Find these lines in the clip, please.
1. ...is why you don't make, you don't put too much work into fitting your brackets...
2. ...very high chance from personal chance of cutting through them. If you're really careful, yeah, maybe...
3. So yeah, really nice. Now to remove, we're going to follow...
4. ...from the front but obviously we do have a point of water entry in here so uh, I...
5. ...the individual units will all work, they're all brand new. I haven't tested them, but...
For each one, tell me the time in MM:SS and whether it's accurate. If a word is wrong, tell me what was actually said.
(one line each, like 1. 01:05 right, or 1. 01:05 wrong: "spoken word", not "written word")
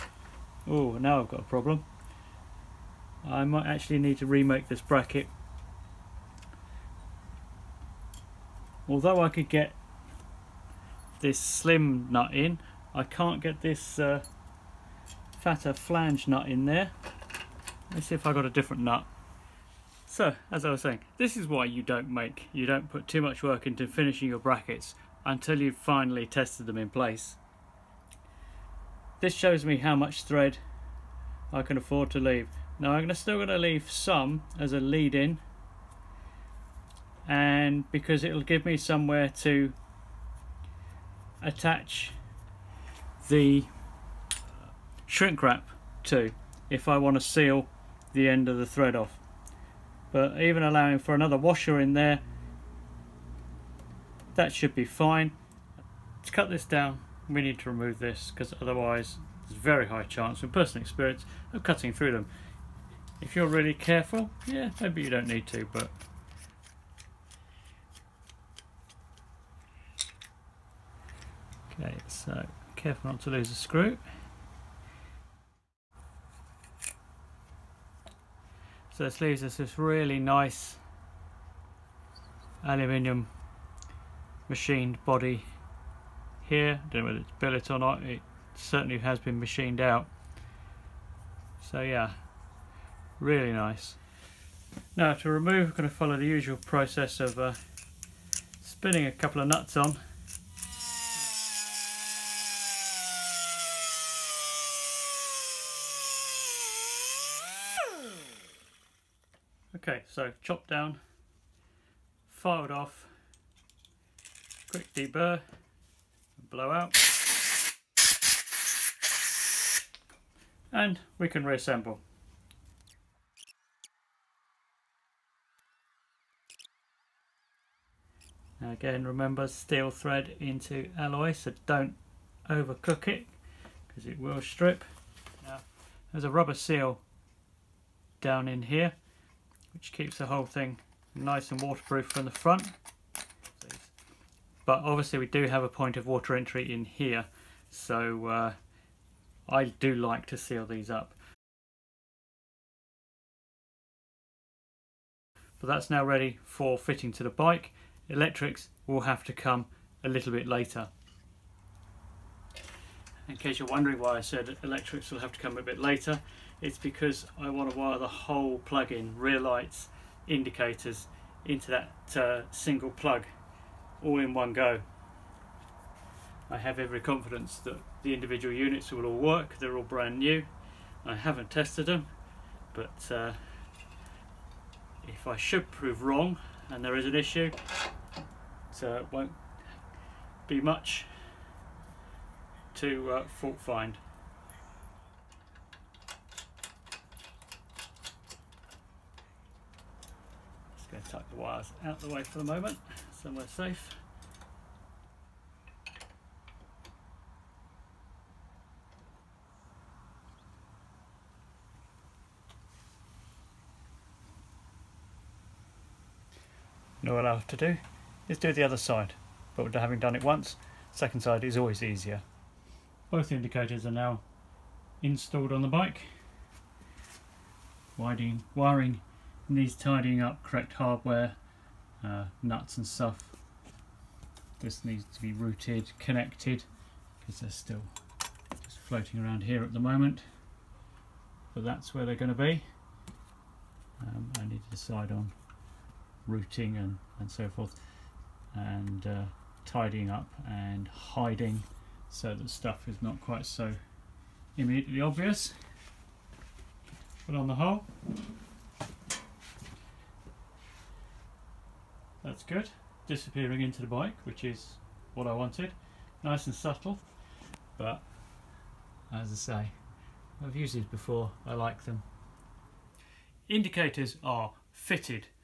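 1. 00:21 wrong: "finishing", not "fitting"
2. 00:59 wrong: "experience", not "chance"
3. 01:31 right
4. 02:22 right
5. 02:58 right.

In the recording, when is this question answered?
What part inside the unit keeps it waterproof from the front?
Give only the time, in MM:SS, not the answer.
02:16.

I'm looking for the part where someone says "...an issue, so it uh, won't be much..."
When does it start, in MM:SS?
03:07.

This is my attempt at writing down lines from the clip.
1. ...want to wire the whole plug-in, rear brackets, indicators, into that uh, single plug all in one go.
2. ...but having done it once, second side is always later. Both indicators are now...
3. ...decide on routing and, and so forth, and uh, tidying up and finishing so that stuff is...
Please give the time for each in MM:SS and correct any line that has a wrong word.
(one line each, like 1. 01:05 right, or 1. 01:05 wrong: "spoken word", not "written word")
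1. 02:47 wrong: "lights", not "brackets"
2. 03:39 wrong: "easier", not "later"
3. 04:04 wrong: "hiding", not "finishing".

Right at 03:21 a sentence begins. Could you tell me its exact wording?
tuck the wires out the way for the moment, somewhere safe.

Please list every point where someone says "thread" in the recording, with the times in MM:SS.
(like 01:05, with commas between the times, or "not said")
00:30, 00:48, 02:09.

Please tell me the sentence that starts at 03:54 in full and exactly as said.
This needs to be routed, connected, because they're still just floating around here at the moment.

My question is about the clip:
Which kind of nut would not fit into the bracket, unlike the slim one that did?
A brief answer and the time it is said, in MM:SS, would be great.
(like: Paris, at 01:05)
Flange nut, at 00:15.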